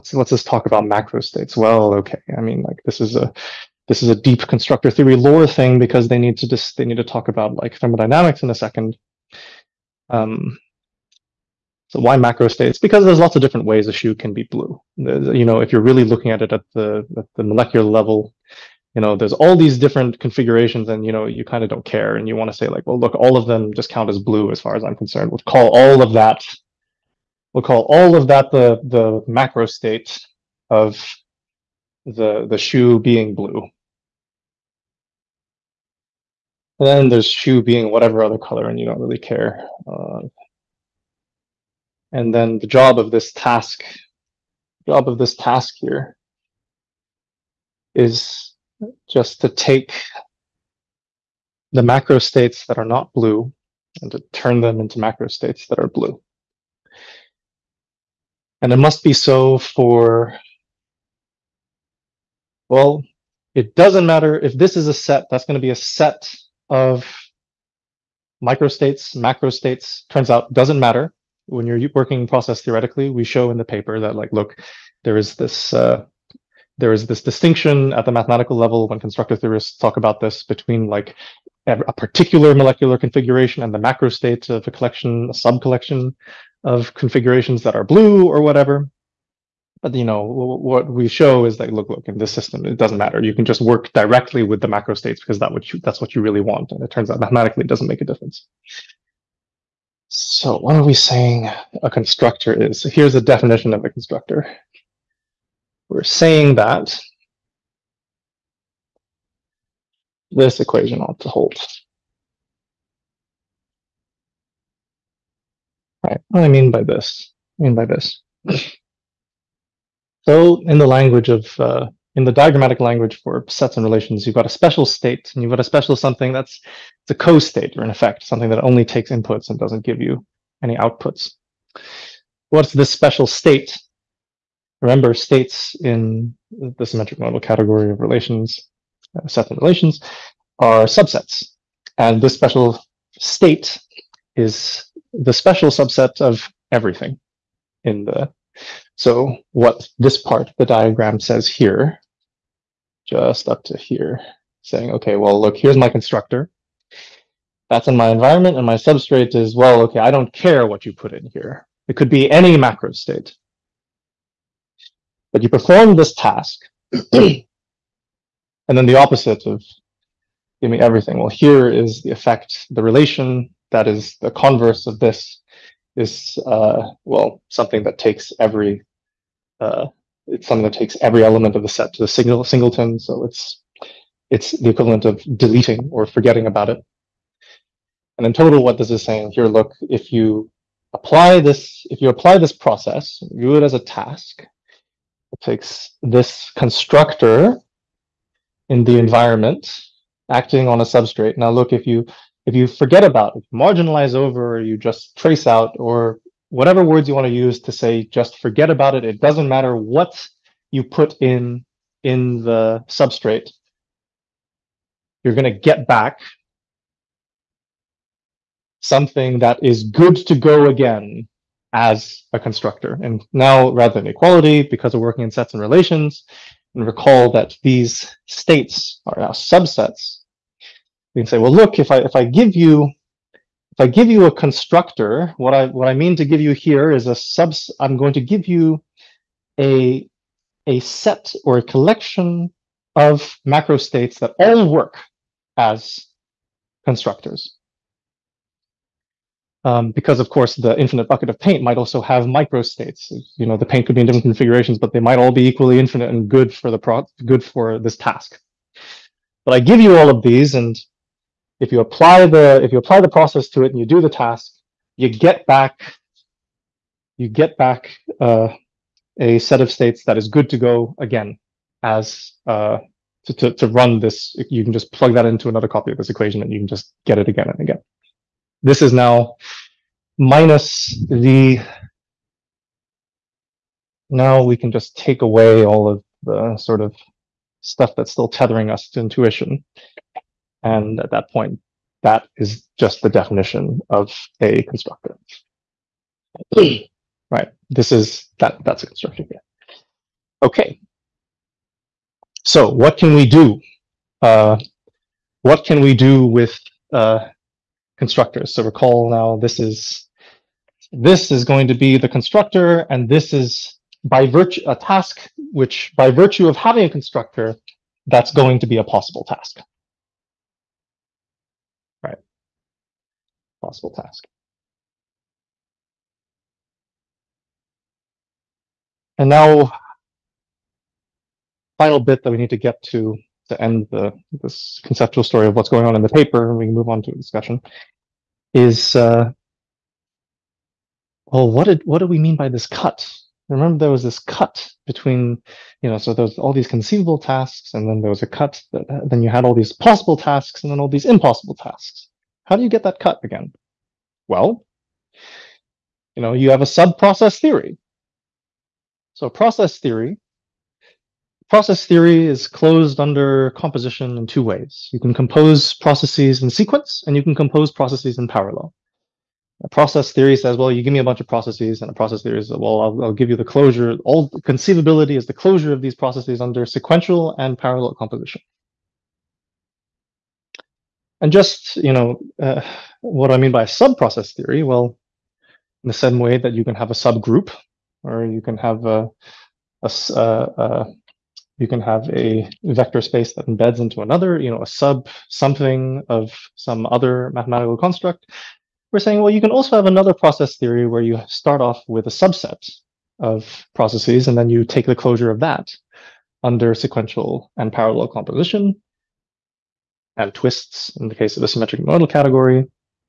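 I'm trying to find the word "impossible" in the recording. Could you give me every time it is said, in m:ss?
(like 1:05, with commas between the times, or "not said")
5:51.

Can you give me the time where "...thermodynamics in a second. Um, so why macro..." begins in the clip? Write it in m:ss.
0:07.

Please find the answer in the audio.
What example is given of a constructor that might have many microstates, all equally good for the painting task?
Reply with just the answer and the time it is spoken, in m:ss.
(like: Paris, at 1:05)
Infinite bucket of paint, at 4:10.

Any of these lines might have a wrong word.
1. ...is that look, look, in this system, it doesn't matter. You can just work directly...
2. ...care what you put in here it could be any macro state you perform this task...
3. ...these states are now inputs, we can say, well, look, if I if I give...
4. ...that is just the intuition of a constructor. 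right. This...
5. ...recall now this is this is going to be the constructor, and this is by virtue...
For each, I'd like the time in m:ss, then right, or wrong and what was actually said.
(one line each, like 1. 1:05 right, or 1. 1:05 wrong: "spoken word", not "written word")
1. 1:31 right
2. 2:40 right
3. 3:47 wrong: "subsets", not "inputs"
4. 4:52 wrong: "definition", not "intuition"
5. 5:08 right.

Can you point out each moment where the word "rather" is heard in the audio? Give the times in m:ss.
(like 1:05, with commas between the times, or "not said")
3:43.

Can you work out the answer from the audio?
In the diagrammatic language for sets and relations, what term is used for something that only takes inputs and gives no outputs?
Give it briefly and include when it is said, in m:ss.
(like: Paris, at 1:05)
Co-state, at 2:07.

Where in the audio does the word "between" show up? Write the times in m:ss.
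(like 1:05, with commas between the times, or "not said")
1:20, 5:44.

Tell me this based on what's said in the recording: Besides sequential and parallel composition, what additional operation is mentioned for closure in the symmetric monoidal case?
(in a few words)
Twists.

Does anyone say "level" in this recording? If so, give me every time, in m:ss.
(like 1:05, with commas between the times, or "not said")
0:17, 1:18.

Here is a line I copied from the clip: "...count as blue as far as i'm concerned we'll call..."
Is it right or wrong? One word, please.
right.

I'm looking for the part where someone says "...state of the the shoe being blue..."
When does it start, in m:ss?
0:29.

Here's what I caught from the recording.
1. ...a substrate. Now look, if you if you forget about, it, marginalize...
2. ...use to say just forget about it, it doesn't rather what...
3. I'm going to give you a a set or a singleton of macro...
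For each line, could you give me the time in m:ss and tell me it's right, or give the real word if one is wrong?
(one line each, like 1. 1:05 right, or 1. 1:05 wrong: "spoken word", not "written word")
1. 3:20 right
2. 3:27 wrong: "matter", not "rather"
3. 3:57 wrong: "collection", not "singleton".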